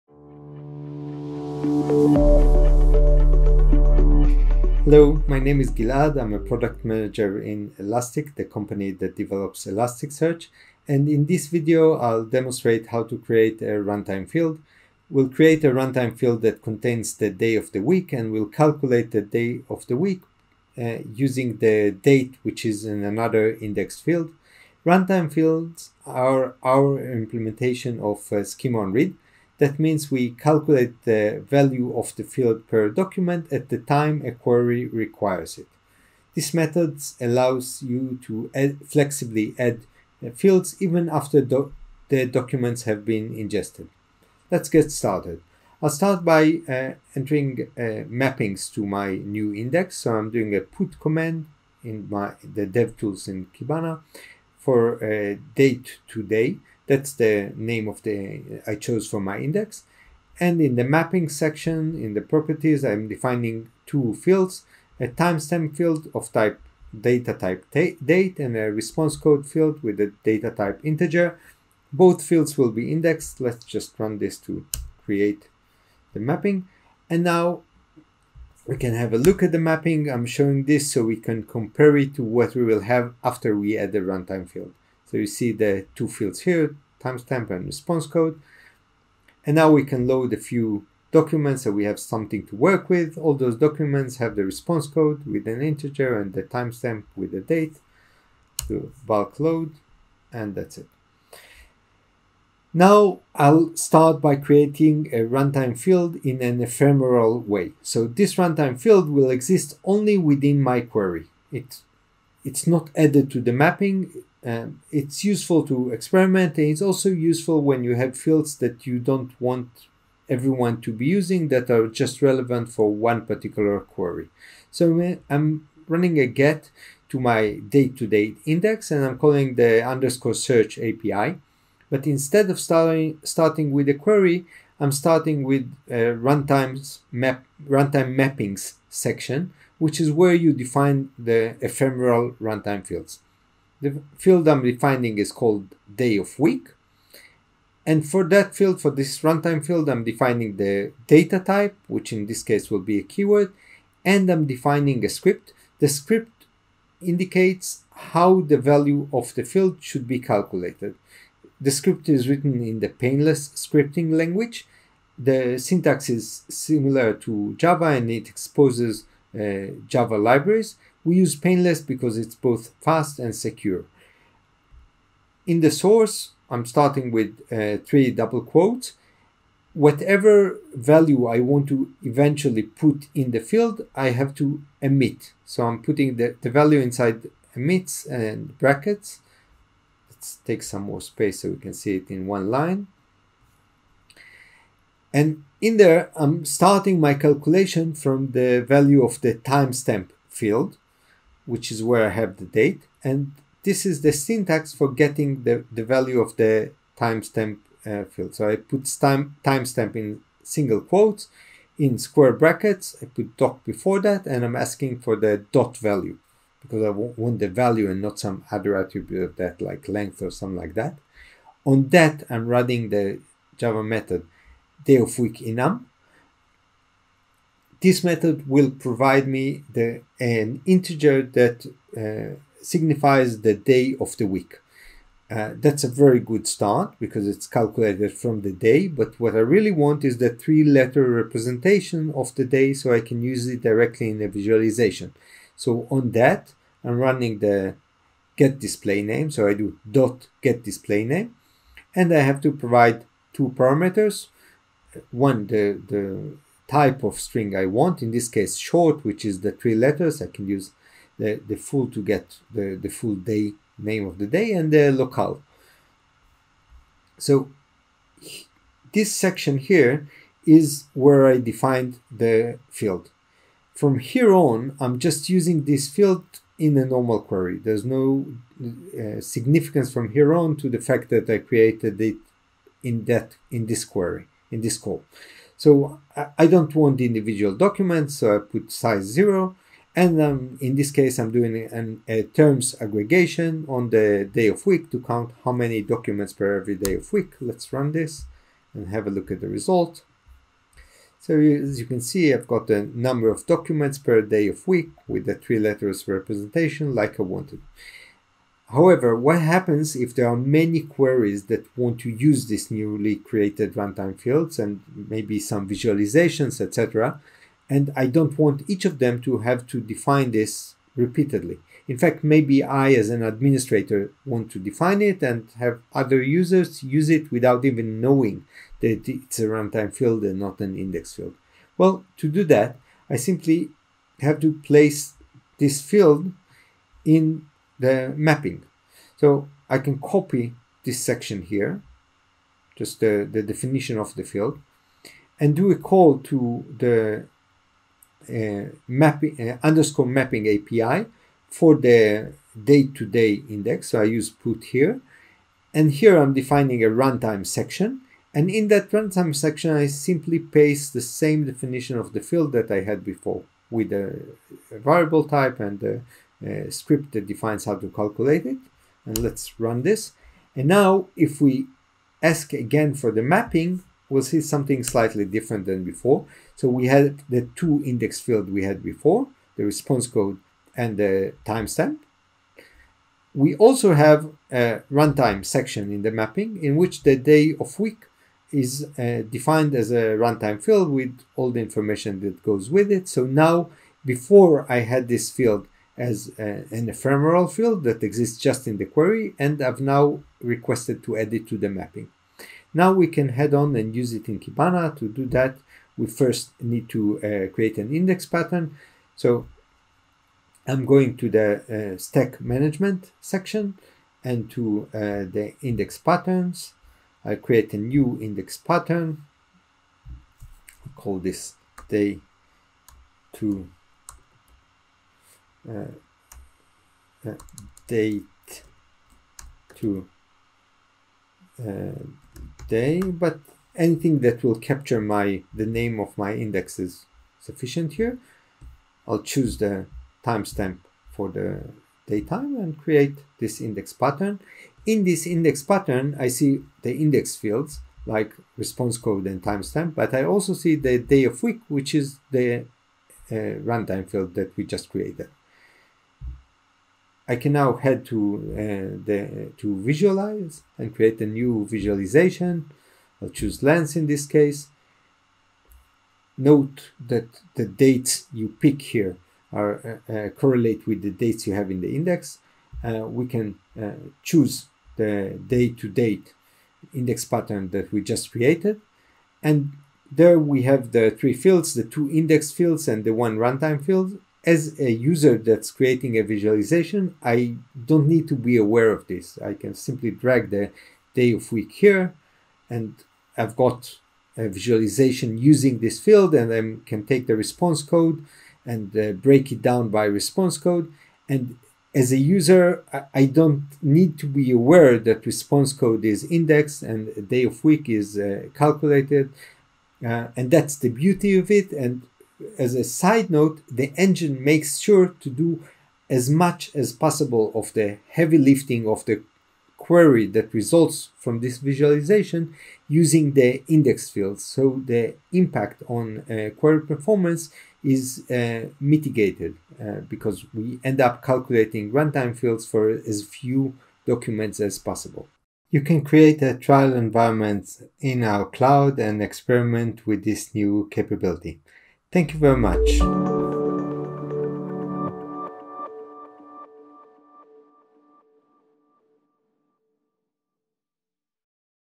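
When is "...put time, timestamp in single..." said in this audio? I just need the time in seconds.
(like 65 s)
208 s.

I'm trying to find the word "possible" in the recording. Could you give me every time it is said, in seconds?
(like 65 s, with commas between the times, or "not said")
516 s, 534 s.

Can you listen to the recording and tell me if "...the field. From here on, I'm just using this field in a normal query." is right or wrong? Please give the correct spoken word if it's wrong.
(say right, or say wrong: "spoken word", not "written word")
right.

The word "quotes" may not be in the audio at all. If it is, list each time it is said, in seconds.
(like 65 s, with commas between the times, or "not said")
178 s, 210 s.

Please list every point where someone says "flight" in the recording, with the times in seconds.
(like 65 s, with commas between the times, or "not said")
not said.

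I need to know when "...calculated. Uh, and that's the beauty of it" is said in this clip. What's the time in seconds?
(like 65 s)
508 s.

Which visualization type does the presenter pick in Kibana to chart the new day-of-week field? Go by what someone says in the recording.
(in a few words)
Lens.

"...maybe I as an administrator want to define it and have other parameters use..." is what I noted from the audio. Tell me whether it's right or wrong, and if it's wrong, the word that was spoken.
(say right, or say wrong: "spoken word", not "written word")
wrong: "users", not "parameters".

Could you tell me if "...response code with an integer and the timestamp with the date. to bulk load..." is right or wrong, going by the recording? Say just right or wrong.
right.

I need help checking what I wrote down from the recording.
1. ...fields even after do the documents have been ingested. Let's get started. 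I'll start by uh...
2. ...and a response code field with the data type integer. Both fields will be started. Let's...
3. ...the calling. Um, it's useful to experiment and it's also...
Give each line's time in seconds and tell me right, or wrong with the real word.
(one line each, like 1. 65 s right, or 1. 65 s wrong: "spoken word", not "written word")
1. 40 s right
2. 68 s wrong: "indexed", not "started"
3. 113 s wrong: "mapping", not "calling".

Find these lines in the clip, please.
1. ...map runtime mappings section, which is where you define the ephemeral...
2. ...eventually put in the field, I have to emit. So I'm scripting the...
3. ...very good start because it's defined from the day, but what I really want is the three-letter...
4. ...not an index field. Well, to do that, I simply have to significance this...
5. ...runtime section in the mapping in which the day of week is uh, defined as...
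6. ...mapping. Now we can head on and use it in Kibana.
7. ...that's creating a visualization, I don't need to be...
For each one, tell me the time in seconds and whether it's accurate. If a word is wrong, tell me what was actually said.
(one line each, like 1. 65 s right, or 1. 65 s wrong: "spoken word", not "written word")
1. 137 s right
2. 182 s wrong: "putting", not "scripting"
3. 235 s wrong: "calculated", not "defined"
4. 330 s wrong: "place", not "significance"
5. 384 s right
6. 401 s right
7. 485 s right.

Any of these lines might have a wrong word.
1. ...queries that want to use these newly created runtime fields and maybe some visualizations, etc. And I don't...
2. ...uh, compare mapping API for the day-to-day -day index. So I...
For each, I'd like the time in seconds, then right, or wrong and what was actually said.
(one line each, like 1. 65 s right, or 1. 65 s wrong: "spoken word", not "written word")
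1. 310 s right
2. 349 s wrong: "underscore", not "compare".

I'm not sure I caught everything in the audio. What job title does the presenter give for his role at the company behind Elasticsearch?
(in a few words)
Product manager.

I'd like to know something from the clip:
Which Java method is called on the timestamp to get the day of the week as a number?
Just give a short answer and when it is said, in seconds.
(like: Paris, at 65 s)
day of week enum, at 224 s.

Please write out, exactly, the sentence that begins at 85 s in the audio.
So you see the two fields here, timestamp and response code.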